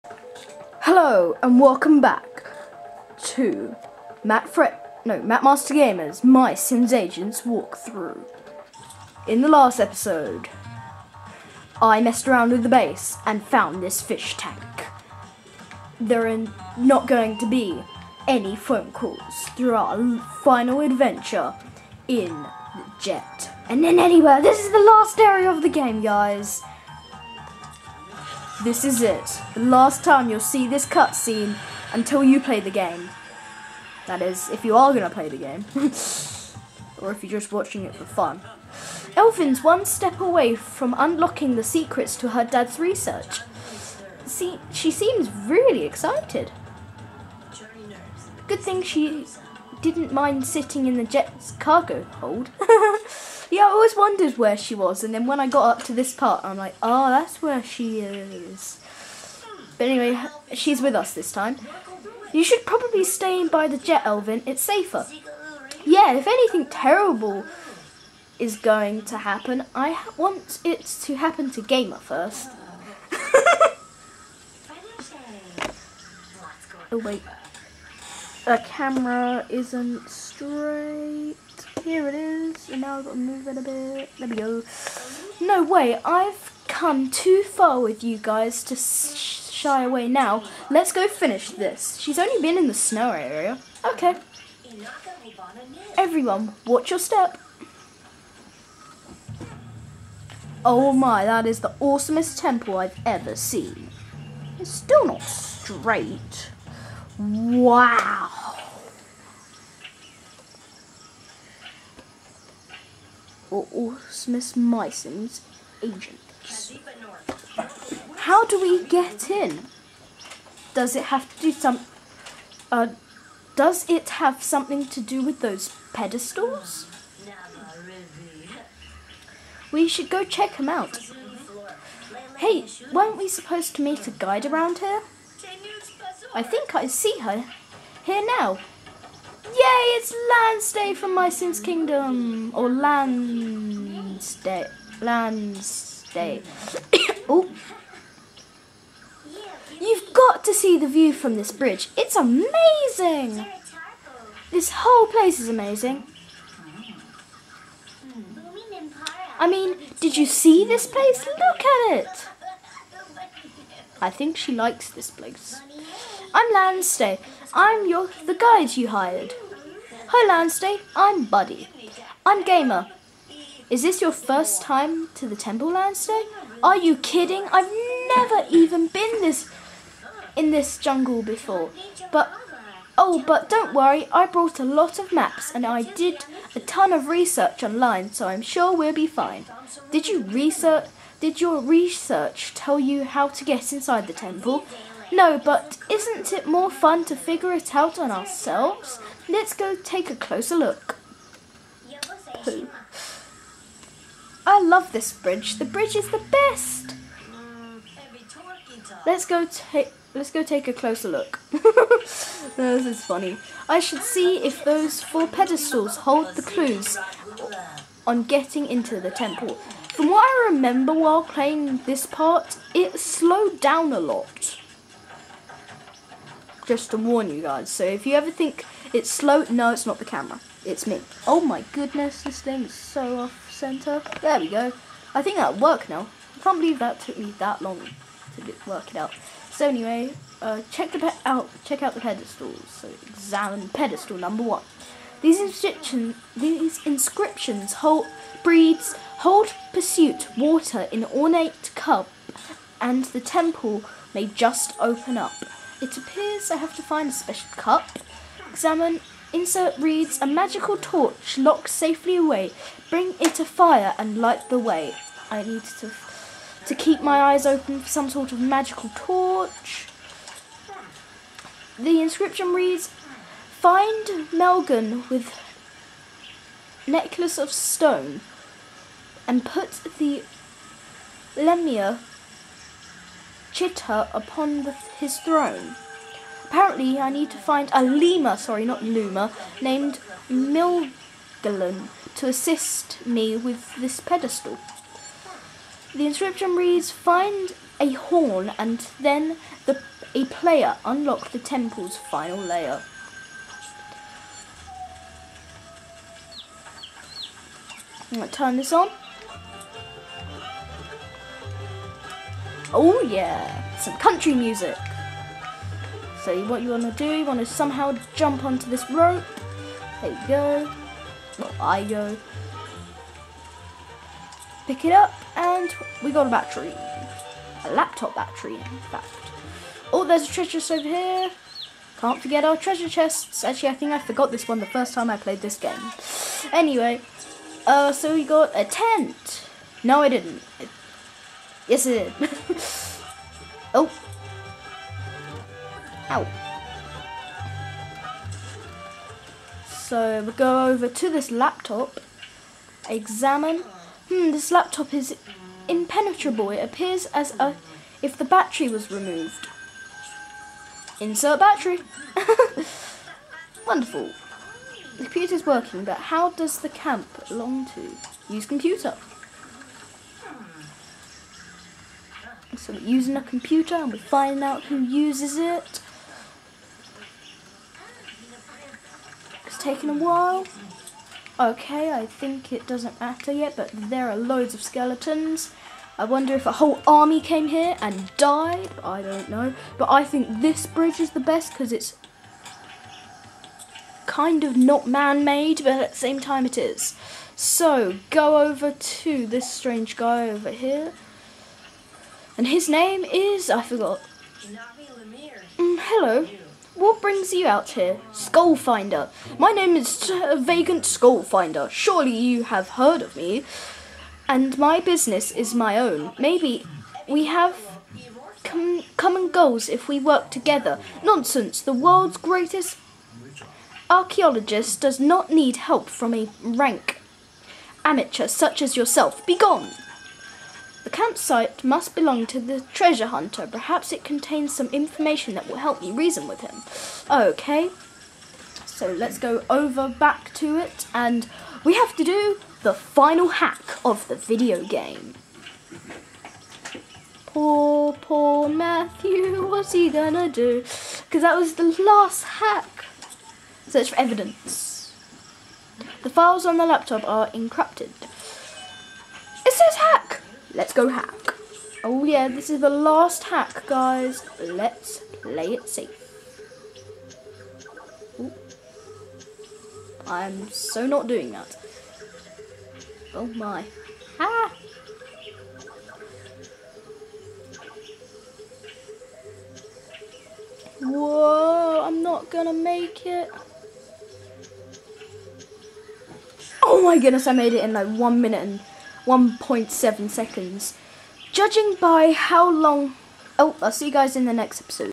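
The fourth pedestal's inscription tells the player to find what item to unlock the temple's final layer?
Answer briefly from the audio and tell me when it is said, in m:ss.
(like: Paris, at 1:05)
a horn, at 4:57.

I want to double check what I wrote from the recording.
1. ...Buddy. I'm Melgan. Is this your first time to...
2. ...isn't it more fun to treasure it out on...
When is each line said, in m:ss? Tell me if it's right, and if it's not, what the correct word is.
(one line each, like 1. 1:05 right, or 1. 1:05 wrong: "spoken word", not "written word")
1. 2:51 wrong: "Gamer", not "Melgan"
2. 3:15 wrong: "figure", not "treasure".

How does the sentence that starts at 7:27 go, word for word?
Poor, poor Matthew, what's he gonna do?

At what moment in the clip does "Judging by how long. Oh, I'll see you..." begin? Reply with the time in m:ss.
8:11.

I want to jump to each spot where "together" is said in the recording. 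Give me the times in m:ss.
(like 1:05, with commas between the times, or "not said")
7:00.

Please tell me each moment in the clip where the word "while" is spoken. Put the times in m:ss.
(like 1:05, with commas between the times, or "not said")
3:40, 6:19.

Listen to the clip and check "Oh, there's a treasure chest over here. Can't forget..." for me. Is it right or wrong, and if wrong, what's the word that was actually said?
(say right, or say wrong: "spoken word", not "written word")
right.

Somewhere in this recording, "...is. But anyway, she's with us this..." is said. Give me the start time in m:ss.
0:58.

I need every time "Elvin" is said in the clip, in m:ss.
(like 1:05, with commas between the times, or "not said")
0:39, 1:04.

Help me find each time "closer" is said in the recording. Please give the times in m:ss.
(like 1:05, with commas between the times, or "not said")
3:20, 3:30.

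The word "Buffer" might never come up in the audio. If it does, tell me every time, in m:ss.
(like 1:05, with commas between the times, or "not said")
not said.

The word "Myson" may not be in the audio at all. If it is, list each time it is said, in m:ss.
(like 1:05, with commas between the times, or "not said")
1:54.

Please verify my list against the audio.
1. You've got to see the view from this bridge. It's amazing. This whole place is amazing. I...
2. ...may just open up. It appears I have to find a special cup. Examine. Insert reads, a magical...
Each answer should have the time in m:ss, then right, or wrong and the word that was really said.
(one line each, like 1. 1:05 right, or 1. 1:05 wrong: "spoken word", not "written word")
1. 2:29 right
2. 4:14 right.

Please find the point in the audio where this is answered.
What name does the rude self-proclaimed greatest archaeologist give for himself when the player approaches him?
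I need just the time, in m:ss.
6:50.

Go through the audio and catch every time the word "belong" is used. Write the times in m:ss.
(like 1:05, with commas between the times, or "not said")
6:07, 7:11.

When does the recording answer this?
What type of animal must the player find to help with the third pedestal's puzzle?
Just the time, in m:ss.
4:47.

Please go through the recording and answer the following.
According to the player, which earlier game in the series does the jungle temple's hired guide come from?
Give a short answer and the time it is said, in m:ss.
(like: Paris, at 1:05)
My Sims Kingdom, at 2:21.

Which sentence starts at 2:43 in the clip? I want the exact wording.
I think she likes this place.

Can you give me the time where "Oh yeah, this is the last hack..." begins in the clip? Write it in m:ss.
7:41.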